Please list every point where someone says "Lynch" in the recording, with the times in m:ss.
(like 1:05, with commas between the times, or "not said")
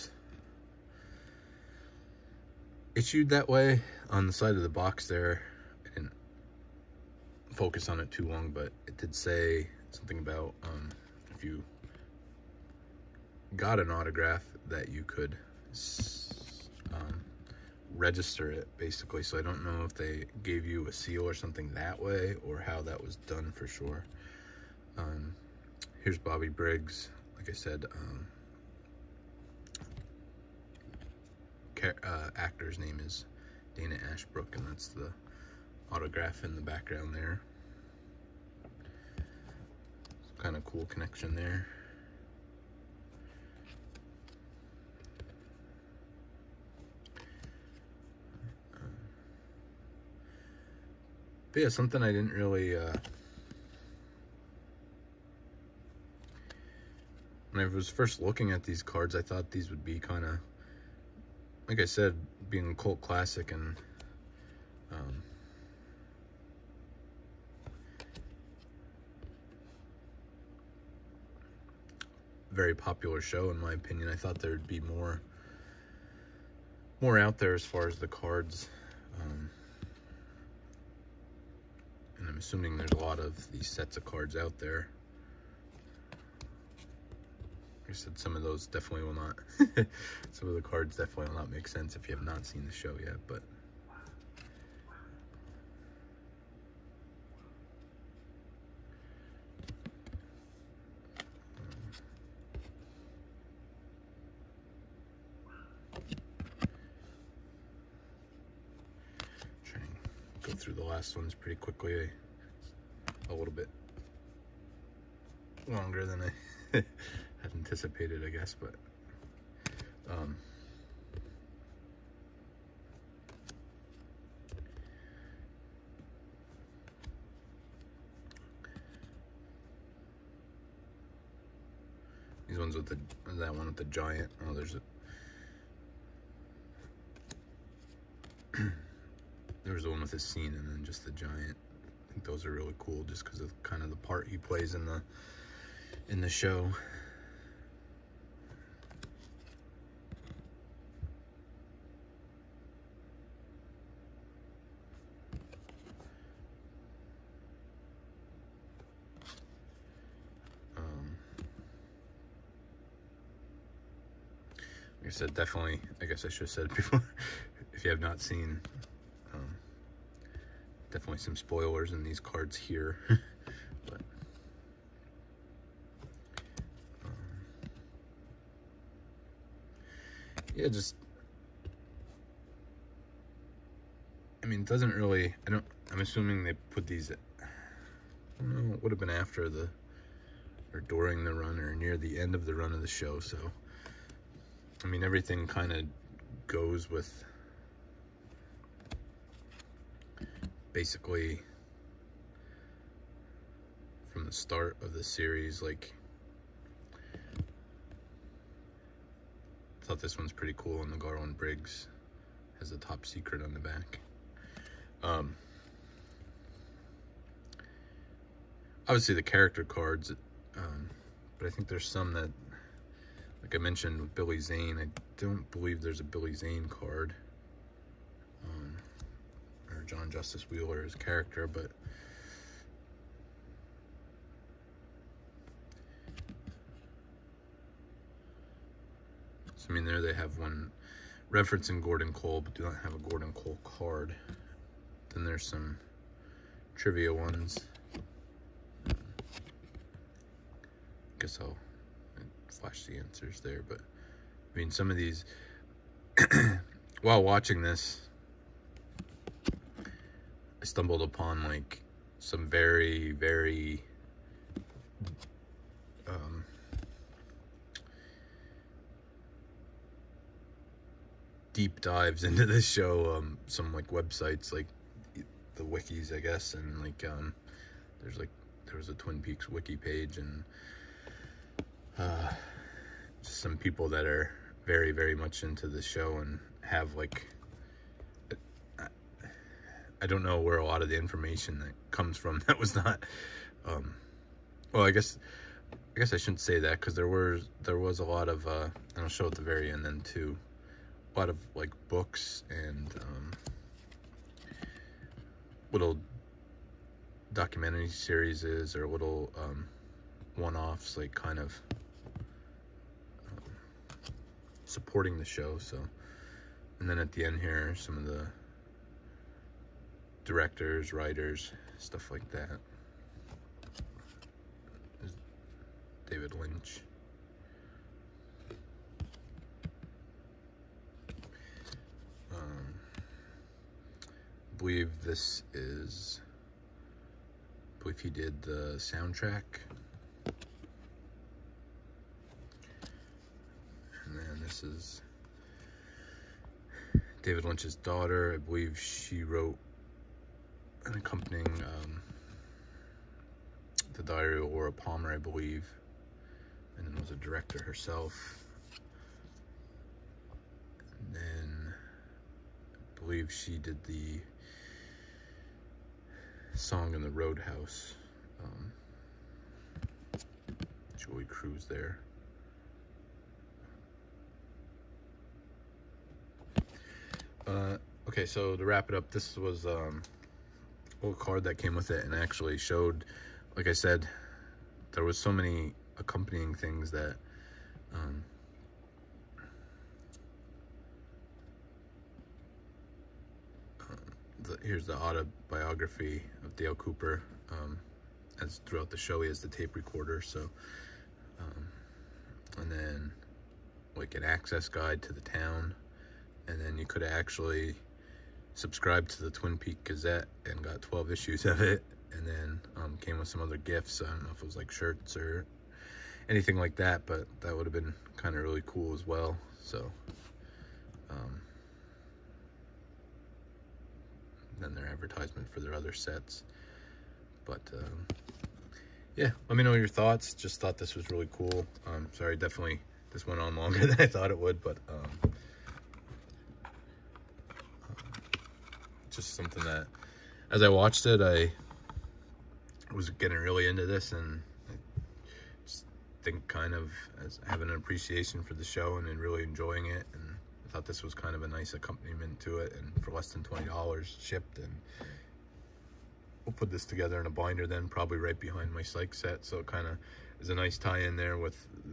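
5:26, 5:47.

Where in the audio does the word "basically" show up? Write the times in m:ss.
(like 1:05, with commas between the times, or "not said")
0:18, 3:20.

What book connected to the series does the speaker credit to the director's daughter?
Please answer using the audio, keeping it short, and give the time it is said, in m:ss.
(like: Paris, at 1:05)
The Diary of Laura Palmer, at 5:53.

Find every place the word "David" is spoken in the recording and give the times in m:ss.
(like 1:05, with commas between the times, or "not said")
5:26, 5:47.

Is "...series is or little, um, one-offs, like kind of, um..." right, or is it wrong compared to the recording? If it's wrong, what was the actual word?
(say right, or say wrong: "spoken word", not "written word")
right.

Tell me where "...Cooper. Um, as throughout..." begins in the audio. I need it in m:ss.
6:36.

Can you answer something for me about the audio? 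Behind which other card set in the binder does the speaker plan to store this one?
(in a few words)
Psych.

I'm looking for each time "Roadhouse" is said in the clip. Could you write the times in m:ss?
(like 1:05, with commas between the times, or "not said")
6:07.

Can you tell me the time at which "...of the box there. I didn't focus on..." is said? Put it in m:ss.
0:04.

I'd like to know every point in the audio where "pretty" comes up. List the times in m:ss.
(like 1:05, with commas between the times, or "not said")
1:51, 3:30.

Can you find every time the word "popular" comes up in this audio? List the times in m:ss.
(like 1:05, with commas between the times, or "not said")
1:12.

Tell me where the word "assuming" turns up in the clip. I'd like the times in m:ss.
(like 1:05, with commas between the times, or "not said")
1:22, 3:05.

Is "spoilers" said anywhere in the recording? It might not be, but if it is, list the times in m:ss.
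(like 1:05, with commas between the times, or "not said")
2:51.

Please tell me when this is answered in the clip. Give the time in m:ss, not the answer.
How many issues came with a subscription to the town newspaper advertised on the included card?
6:50.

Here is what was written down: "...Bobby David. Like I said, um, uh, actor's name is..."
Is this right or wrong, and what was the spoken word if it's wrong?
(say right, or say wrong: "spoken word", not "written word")
wrong: "Briggs", not "David".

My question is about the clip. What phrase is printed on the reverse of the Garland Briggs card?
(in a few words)
top secret.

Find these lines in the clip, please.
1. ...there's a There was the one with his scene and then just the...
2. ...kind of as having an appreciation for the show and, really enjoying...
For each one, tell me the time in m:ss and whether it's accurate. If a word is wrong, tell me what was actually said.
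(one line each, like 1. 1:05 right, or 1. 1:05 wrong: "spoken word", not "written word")
1. 2:14 right
2. 7:26 right.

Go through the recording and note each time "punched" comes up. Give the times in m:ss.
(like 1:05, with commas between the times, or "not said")
not said.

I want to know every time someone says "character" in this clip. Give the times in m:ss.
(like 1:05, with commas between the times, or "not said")
3:39, 3:50.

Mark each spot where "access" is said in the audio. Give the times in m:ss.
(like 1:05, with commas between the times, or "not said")
6:44.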